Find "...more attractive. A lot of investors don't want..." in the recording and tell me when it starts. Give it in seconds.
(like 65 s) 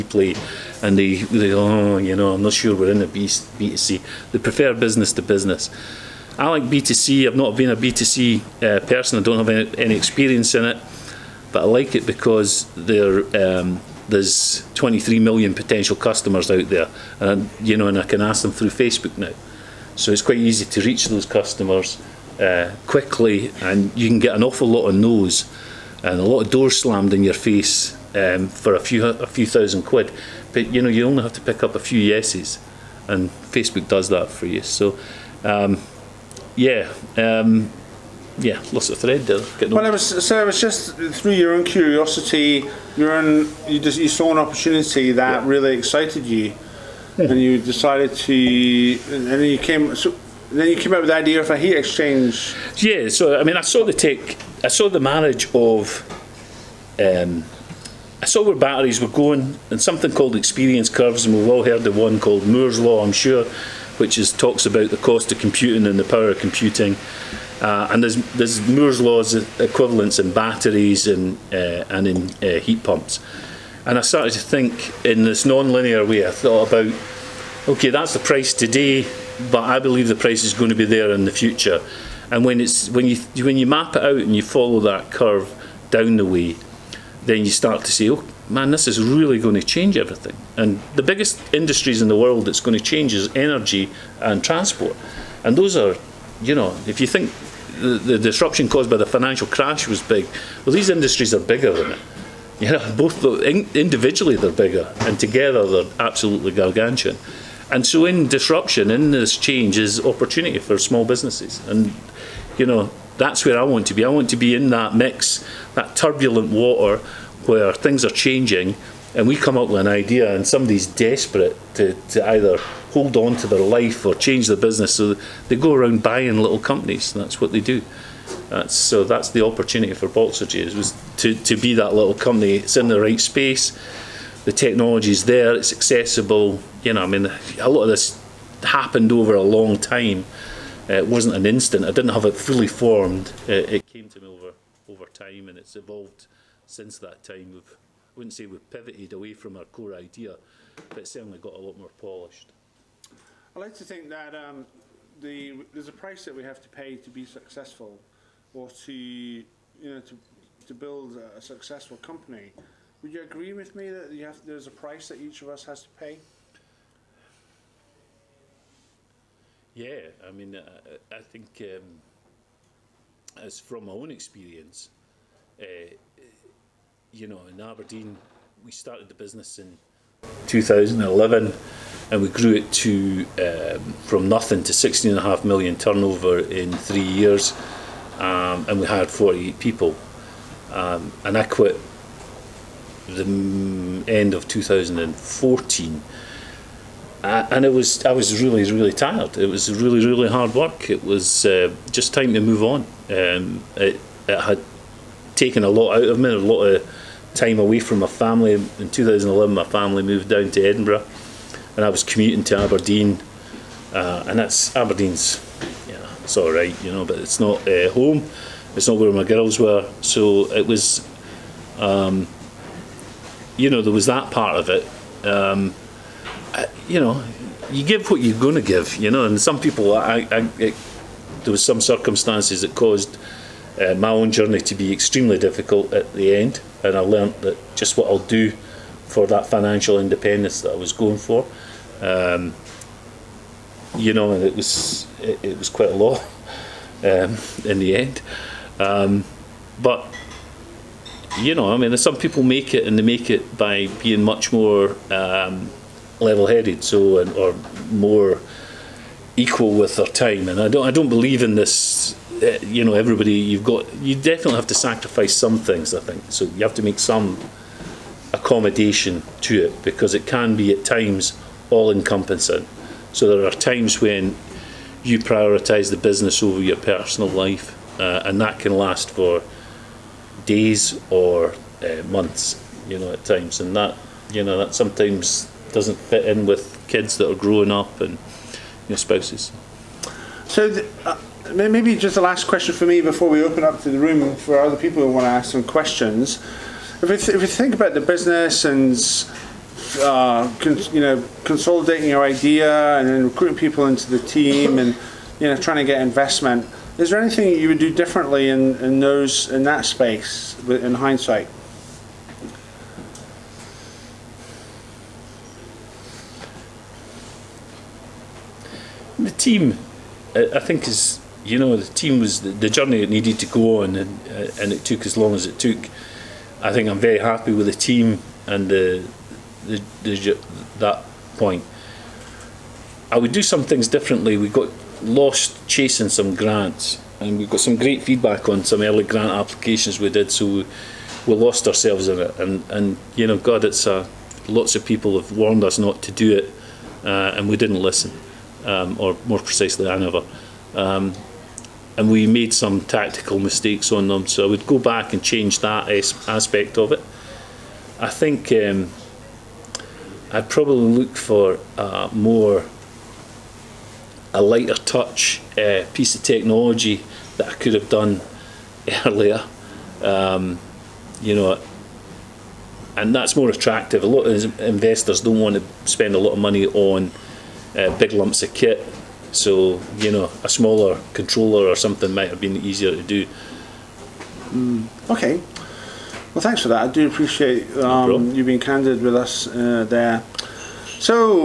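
373 s.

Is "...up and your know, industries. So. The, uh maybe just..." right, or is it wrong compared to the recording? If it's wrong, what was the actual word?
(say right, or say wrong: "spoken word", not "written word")
wrong: "spouses", not "industries".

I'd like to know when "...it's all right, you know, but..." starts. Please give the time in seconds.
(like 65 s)
216 s.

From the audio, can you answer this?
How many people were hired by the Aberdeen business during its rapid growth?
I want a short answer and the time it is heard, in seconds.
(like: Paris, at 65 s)
48, at 189 s.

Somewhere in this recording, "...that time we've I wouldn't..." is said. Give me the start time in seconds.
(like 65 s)
146 s.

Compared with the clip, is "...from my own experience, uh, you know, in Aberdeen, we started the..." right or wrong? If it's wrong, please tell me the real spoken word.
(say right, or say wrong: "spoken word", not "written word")
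right.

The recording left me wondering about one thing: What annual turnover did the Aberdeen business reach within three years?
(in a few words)
16.5 million.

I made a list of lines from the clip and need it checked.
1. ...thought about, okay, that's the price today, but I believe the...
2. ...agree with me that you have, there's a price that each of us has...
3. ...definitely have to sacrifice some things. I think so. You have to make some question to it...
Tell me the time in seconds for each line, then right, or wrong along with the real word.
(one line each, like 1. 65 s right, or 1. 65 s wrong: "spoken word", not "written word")
1. 76 s right
2. 163 s right
3. 264 s wrong: "accommodation", not "question".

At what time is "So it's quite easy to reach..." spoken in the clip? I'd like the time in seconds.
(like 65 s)
19 s.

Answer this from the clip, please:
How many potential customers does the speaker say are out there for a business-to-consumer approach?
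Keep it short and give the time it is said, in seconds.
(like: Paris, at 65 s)
23 million, at 14 s.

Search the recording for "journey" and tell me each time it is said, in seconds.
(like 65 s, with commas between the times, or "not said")
234 s, 322 s.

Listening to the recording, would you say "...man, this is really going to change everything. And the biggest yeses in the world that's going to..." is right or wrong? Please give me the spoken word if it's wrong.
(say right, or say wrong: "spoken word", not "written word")
wrong: "industries", not "yeses".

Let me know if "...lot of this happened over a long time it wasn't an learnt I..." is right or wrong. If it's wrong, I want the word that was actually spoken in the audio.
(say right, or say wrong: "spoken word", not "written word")
wrong: "instant", not "learnt".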